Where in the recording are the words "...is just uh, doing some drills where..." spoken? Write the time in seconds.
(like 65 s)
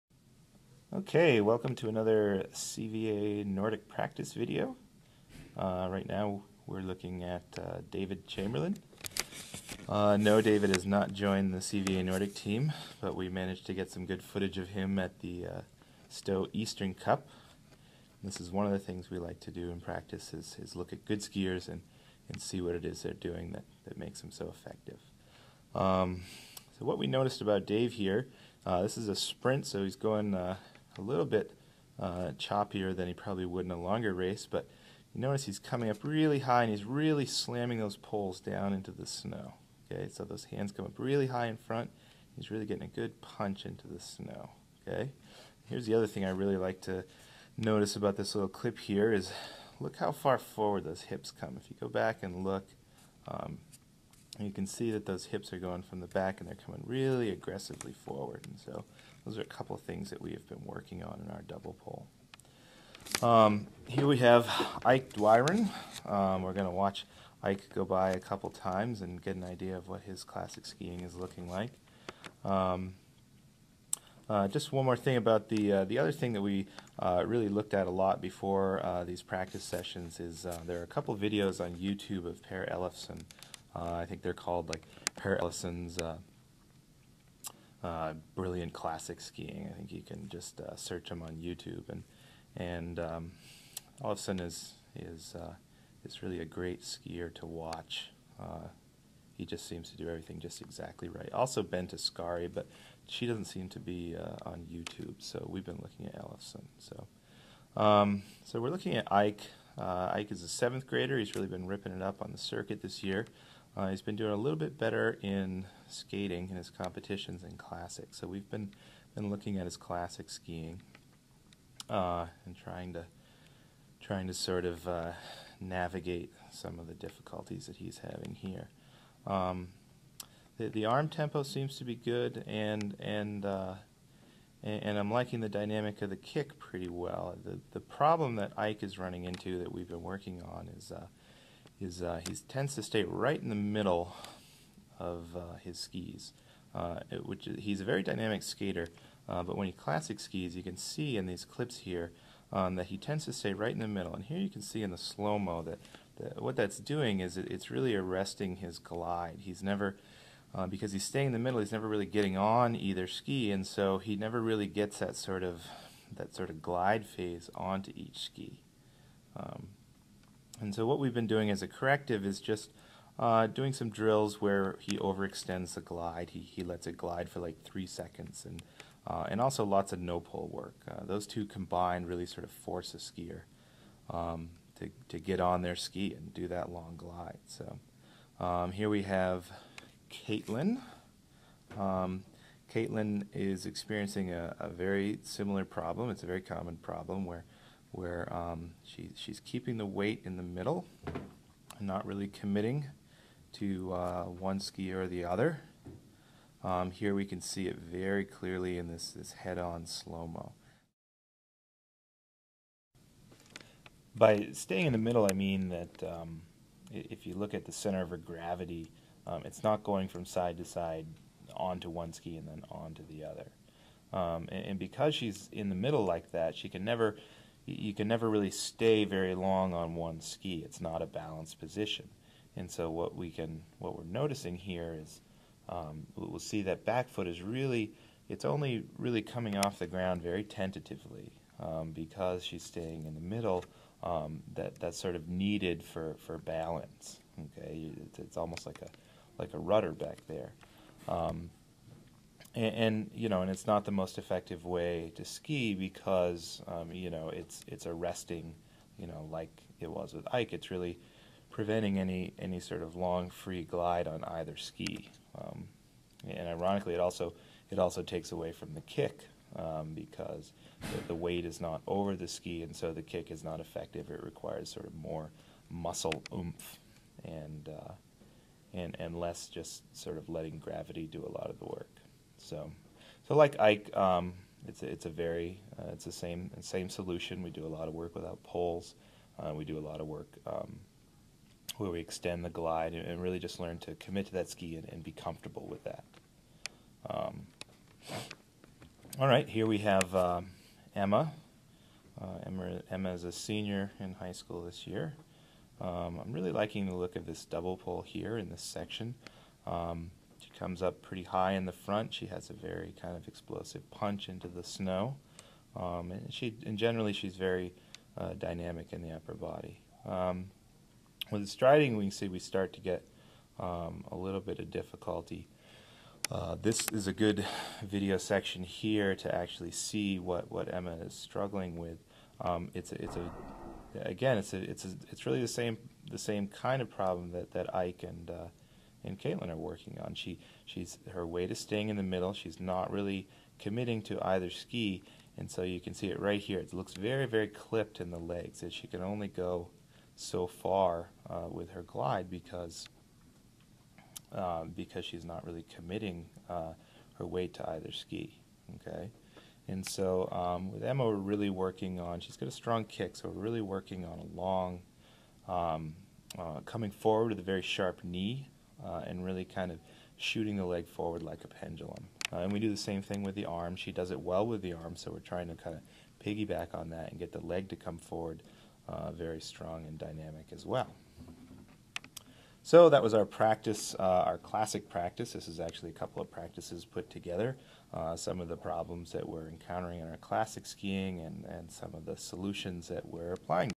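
172 s.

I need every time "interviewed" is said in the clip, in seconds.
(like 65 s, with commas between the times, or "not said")
not said.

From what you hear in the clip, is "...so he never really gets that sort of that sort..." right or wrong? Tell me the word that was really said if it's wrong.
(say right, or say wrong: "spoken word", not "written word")
right.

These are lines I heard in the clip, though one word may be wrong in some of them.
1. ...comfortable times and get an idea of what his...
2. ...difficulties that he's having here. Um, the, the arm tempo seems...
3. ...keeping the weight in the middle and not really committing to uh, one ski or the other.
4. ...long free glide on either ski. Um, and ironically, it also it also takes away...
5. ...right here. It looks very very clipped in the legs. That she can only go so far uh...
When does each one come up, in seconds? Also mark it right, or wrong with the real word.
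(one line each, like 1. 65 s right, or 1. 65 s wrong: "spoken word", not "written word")
1. 68 s wrong: "couple", not "comfortable"
2. 126 s right
3. 199 s right
4. 262 s right
5. 346 s right.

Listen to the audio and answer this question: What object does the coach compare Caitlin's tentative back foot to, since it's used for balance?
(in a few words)
a rudder.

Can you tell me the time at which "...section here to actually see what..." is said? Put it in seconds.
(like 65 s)
328 s.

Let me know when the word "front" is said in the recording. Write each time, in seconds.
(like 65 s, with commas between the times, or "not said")
41 s, 311 s.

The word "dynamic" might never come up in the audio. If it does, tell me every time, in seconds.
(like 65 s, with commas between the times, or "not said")
135 s, 148 s, 318 s, 379 s.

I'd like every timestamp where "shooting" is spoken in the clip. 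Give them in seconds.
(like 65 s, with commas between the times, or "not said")
370 s.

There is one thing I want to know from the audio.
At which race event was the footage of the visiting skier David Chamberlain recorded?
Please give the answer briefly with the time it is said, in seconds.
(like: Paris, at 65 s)
Stowe Eastern Cup, at 16 s.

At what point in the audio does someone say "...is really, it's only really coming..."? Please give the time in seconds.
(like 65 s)
237 s.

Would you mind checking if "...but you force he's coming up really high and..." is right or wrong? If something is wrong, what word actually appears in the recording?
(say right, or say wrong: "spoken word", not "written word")
wrong: "notice", not "force".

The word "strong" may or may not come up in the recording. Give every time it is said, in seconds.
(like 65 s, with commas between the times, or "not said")
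362 s, 379 s.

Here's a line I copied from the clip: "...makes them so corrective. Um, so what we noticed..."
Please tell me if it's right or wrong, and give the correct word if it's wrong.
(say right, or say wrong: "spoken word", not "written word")
wrong: "effective", not "corrective".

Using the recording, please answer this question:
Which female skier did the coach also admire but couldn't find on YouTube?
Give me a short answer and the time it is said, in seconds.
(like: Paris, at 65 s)
Bente Skari, at 101 s.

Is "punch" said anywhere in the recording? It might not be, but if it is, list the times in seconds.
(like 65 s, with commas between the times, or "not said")
43 s, 313 s.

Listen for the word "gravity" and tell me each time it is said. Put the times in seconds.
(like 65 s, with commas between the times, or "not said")
218 s, 280 s.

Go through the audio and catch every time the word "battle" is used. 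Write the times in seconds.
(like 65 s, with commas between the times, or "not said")
not said.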